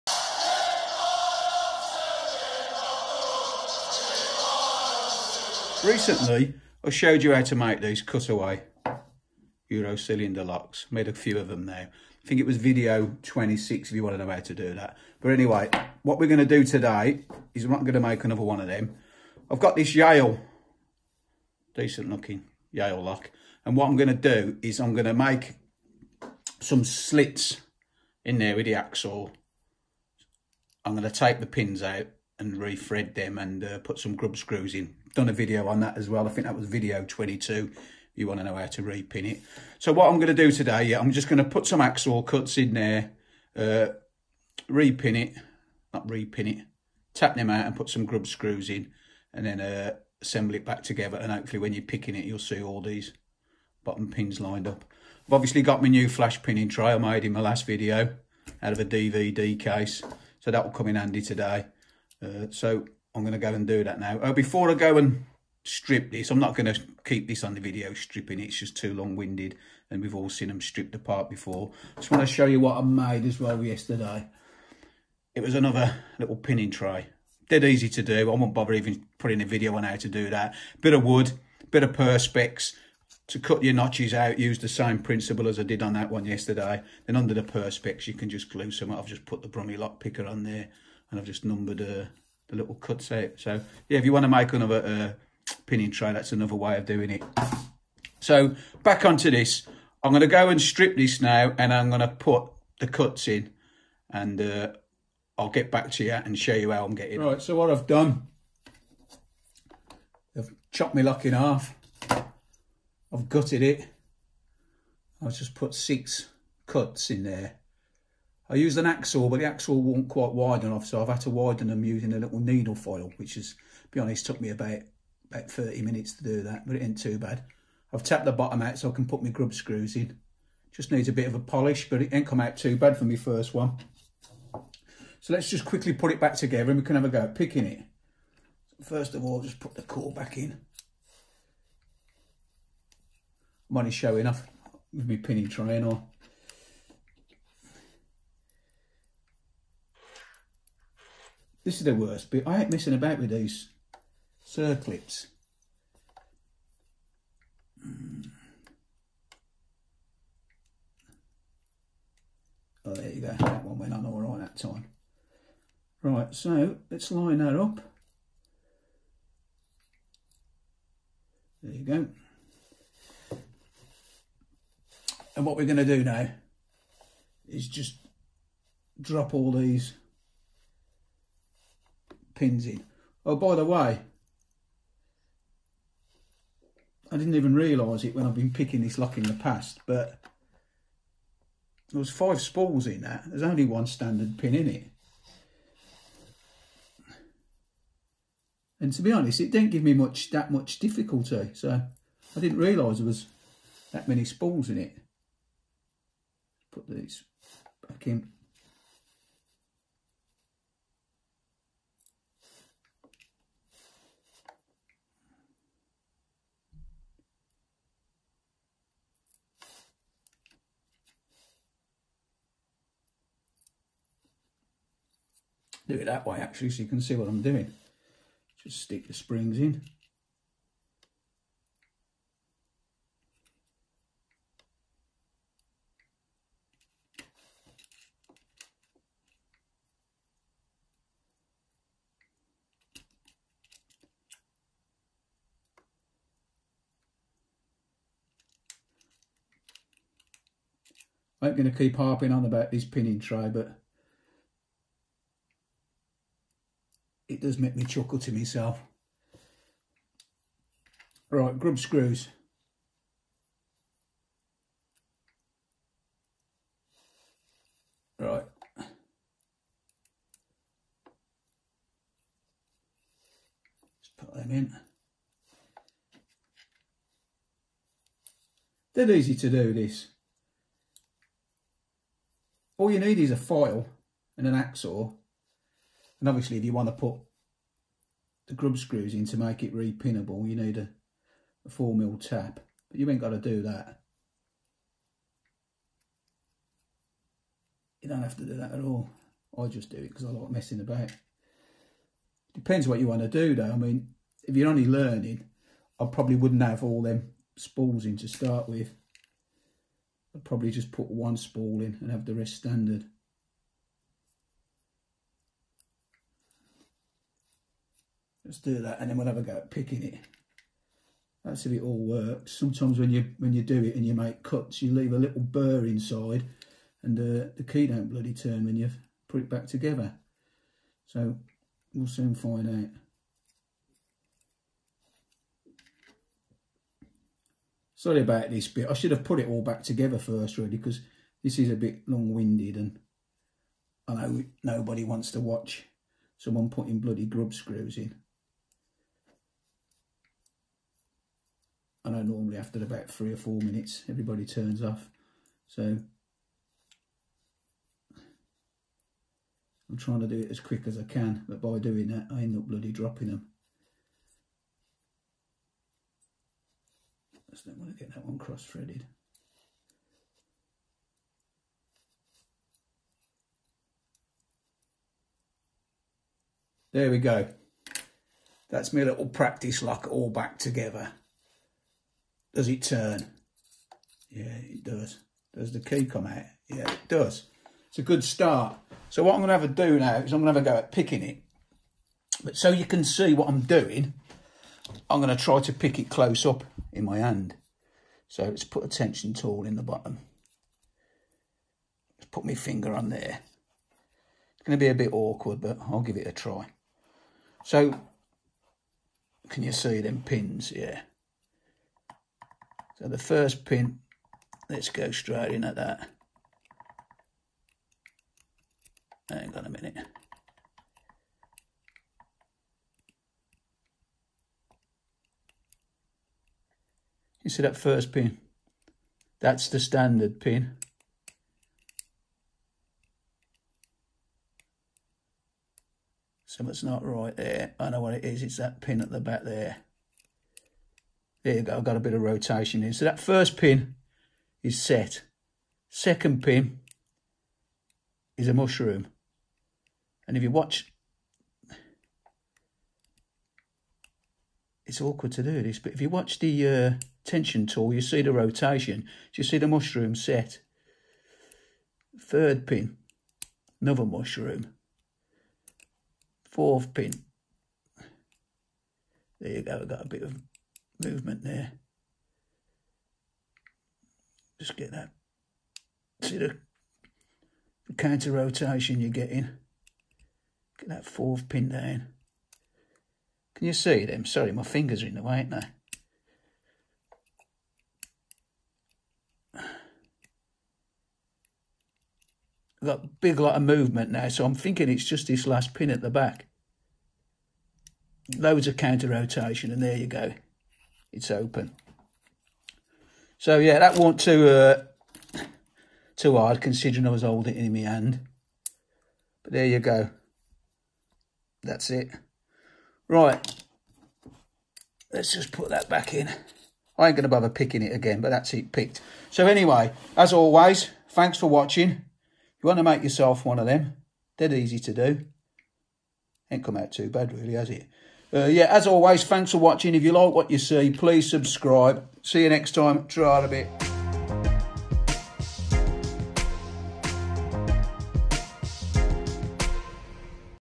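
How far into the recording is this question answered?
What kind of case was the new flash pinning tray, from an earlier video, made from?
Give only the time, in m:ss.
0:58.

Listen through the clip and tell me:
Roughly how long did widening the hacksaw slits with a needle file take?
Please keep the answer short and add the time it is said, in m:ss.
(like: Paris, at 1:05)
30 minutes, at 2:05.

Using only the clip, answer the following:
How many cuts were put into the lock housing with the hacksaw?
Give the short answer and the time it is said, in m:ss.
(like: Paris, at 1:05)
6, at 1:55.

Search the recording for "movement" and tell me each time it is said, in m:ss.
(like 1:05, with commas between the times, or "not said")
7:51, 8:13.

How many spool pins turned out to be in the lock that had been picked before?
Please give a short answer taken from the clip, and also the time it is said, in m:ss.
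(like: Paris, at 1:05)
5, at 3:12.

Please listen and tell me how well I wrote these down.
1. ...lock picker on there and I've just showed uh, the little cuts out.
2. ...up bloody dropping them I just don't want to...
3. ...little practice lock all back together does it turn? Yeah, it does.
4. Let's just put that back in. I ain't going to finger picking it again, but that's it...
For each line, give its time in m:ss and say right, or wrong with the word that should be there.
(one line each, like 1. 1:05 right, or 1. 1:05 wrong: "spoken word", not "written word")
1. 1:29 wrong: "numbered", not "showed"
2. 6:02 right
3. 6:19 right
4. 8:35 wrong: "bother", not "finger".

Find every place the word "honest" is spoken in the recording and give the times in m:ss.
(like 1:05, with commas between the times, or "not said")
2:04, 3:19.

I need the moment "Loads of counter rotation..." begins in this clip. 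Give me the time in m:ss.
8:18.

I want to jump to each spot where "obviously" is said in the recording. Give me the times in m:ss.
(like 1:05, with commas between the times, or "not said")
0:55, 4:46.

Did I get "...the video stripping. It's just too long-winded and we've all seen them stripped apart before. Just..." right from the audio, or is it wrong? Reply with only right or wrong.
right.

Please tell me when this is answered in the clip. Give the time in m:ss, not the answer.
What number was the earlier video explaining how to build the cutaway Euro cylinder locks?
0:13.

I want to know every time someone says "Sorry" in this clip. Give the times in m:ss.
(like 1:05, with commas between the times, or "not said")
5:37, 8:04.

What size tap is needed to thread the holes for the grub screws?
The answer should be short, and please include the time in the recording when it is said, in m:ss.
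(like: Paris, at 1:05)
4 mil, at 4:51.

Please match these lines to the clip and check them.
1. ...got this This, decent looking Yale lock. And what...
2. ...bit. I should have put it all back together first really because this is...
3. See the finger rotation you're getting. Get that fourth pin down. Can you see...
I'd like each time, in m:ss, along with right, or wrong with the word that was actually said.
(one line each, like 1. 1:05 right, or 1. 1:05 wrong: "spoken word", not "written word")
1. 0:19 wrong: "Yale", not "This"
2. 5:38 right
3. 7:56 wrong: "counter", not "finger".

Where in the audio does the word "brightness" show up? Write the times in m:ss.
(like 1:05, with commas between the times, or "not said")
not said.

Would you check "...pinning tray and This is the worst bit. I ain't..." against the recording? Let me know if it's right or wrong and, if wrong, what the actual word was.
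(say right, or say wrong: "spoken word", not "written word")
right.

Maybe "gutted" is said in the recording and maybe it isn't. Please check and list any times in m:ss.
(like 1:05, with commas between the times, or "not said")
1:53.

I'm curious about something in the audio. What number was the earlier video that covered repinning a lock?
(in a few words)
22.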